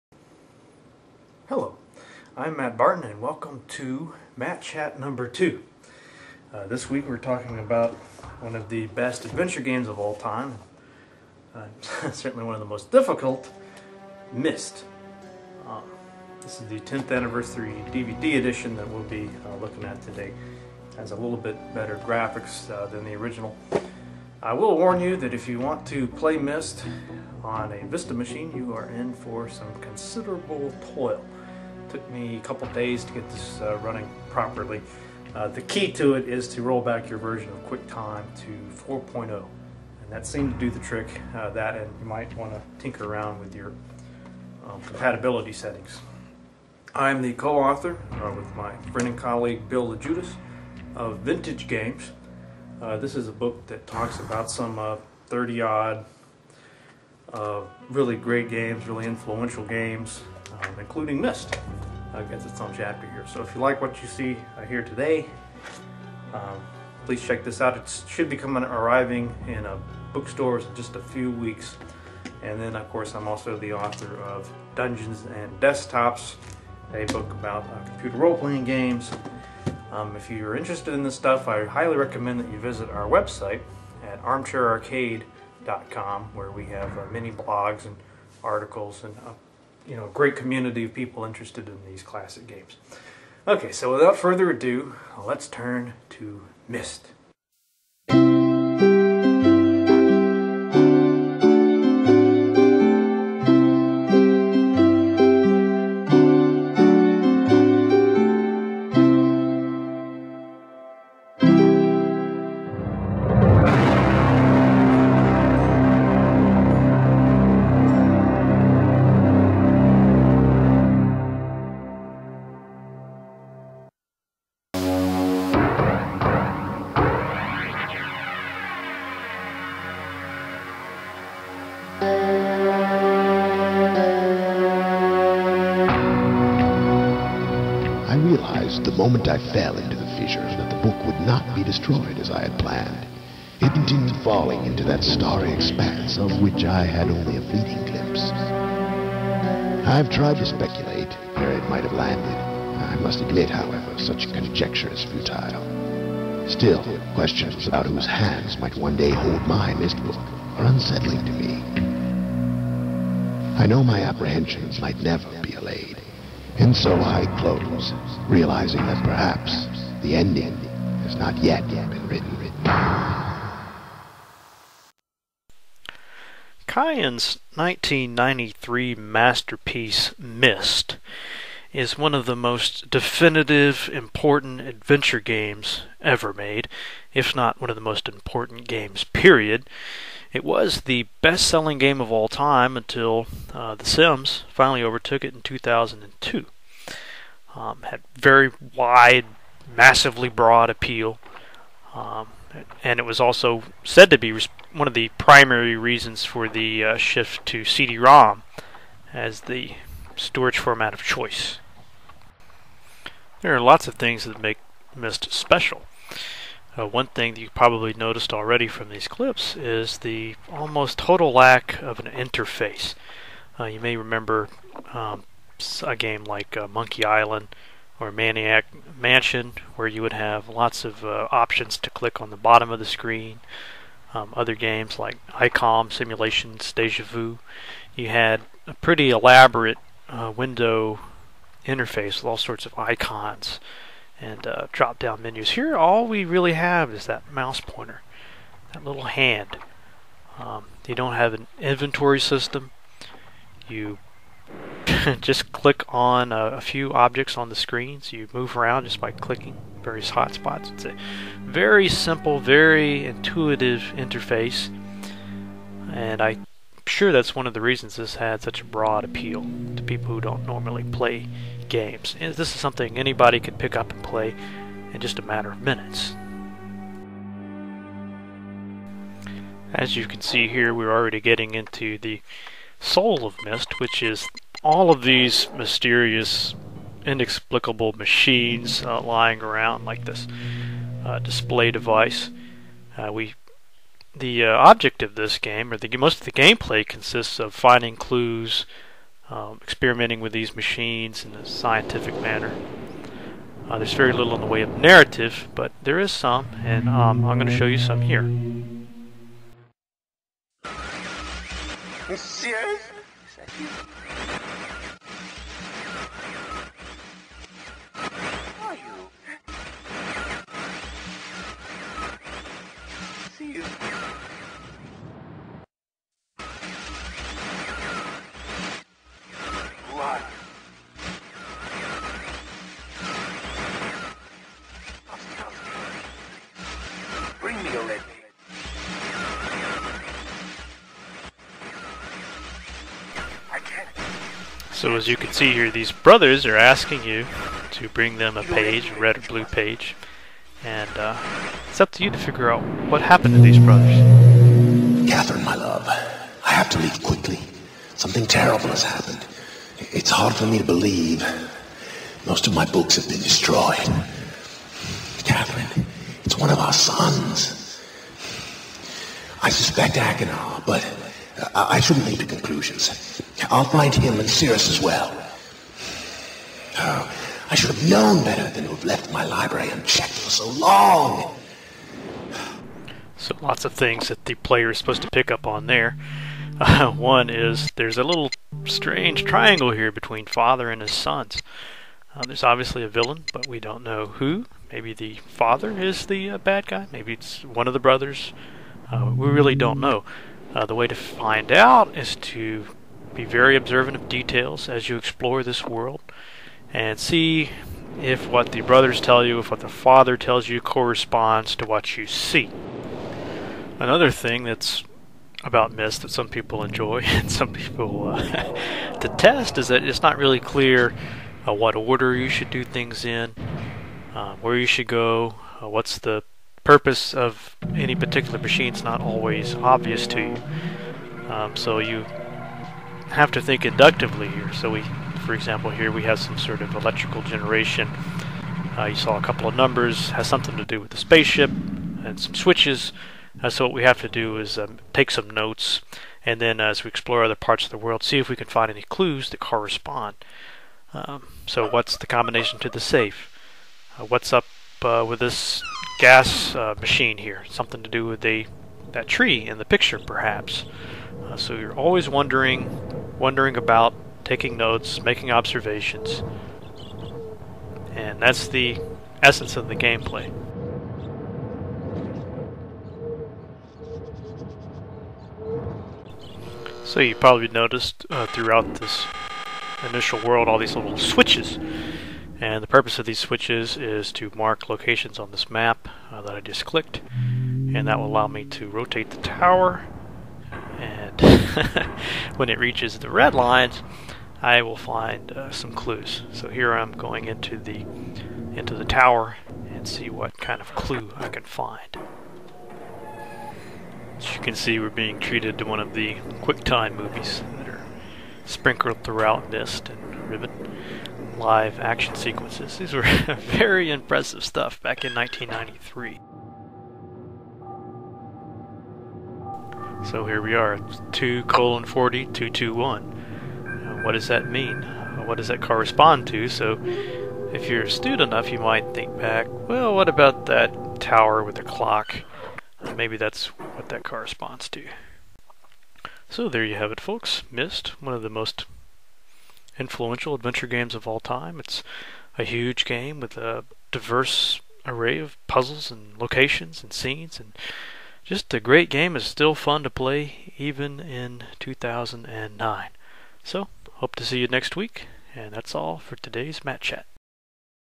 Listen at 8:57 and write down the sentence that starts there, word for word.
Myst one of the most influential adventure games of all time.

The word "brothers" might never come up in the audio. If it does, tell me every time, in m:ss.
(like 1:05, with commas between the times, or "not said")
5:45, 5:53, 6:37, 6:48.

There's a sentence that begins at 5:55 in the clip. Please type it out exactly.
Catherine, my love, I have to leave quickly.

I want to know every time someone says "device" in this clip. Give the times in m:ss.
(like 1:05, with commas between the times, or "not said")
4:51.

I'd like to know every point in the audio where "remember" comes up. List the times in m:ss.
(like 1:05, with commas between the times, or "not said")
3:43.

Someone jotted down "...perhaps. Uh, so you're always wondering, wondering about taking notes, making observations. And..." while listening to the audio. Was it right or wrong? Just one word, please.
right.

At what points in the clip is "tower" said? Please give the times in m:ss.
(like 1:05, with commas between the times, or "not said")
8:09, 8:18, 8:50.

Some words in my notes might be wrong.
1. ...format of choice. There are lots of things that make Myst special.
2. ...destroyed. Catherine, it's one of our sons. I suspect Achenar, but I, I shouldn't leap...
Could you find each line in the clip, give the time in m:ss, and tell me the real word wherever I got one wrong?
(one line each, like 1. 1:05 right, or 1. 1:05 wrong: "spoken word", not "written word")
1. 3:30 right
2. 6:03 right.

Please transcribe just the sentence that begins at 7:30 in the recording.
Um, so what's the combination to the safe?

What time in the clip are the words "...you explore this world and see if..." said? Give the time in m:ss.
6:44.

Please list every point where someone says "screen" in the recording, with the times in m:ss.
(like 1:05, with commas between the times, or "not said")
3:52, 4:17.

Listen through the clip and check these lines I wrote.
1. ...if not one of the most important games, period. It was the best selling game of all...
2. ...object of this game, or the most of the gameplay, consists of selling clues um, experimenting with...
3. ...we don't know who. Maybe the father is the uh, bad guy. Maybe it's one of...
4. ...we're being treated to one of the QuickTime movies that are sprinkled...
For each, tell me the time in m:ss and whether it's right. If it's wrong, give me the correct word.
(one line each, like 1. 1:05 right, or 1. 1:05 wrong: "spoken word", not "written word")
1. 3:07 right
2. 4:54 wrong: "finding", not "selling"
3. 6:33 right
4. 8:24 right.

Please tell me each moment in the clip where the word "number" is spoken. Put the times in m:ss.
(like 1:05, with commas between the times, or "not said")
0:05, 7:19.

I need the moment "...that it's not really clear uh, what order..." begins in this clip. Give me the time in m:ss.
6:59.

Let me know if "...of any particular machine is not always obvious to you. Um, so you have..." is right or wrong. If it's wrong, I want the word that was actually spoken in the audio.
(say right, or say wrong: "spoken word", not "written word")
right.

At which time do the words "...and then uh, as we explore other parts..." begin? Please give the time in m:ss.
7:26.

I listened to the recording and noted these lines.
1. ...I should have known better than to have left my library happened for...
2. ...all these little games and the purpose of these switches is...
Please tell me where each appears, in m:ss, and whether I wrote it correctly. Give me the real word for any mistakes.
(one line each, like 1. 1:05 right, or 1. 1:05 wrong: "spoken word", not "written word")
1. 6:17 wrong: "unchecked", not "happened"
2. 8:00 wrong: "switches", not "games".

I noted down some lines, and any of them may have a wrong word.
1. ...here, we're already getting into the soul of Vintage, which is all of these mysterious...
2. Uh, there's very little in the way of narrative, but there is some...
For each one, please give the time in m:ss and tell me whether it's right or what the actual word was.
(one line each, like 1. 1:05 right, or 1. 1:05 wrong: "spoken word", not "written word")
1. 4:40 wrong: "Myst", not "Vintage"
2. 5:03 right.